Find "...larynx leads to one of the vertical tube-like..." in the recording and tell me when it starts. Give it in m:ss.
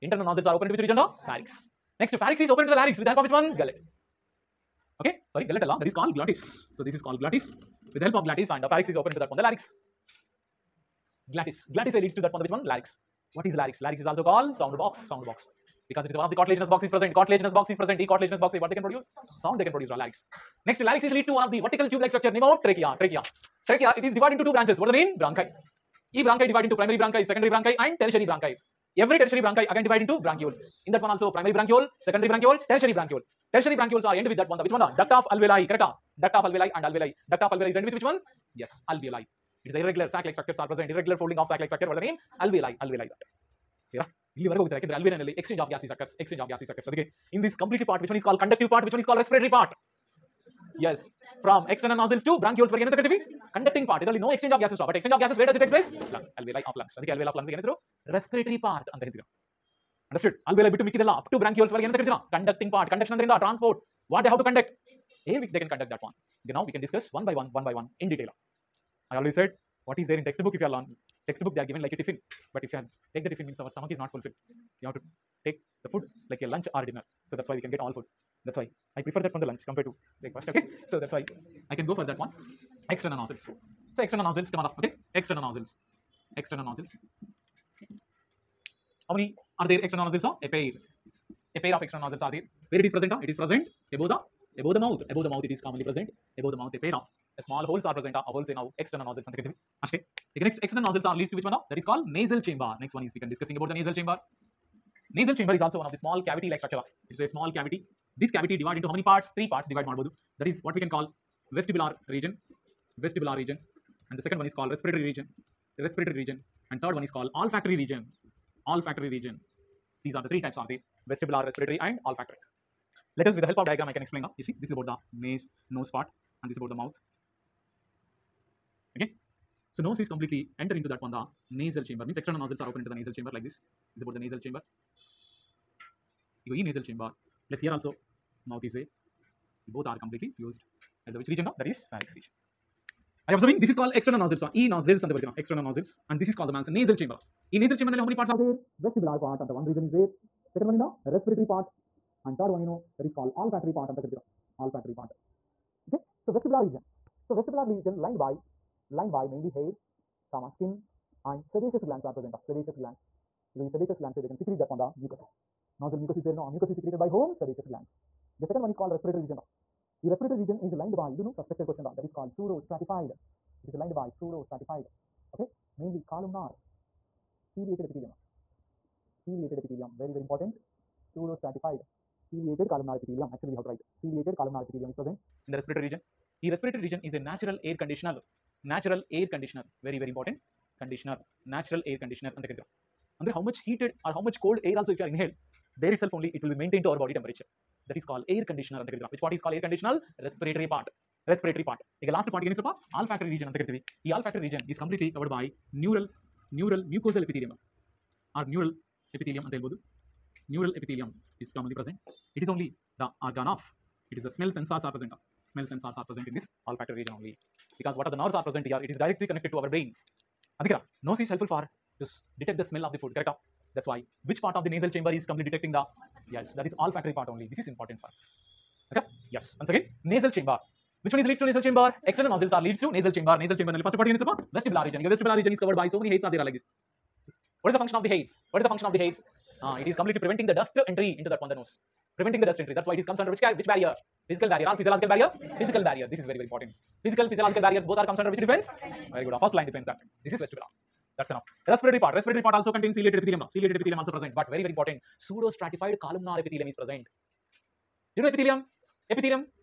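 0:20.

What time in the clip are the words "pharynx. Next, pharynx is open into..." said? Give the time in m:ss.
0:01.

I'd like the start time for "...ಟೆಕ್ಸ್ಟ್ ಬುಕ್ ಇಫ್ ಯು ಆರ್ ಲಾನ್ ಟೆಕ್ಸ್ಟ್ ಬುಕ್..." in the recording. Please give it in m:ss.
1:10.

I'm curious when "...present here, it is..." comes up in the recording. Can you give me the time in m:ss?
3:38.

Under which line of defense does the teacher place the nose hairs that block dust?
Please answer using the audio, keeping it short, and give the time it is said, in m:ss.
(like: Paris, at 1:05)
first line defense, at 4:09.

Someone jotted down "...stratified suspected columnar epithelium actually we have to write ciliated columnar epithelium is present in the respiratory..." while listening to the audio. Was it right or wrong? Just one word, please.
wrong.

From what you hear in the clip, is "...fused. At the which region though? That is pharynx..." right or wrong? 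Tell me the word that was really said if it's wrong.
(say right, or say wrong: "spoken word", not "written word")
right.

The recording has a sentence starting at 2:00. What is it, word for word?
These are the three types are the vestibular, respiratory and olfactory.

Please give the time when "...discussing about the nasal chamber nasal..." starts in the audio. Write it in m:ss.
1:43.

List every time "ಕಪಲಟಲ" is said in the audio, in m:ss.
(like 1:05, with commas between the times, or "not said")
3:24.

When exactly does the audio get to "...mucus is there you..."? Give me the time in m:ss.
2:46.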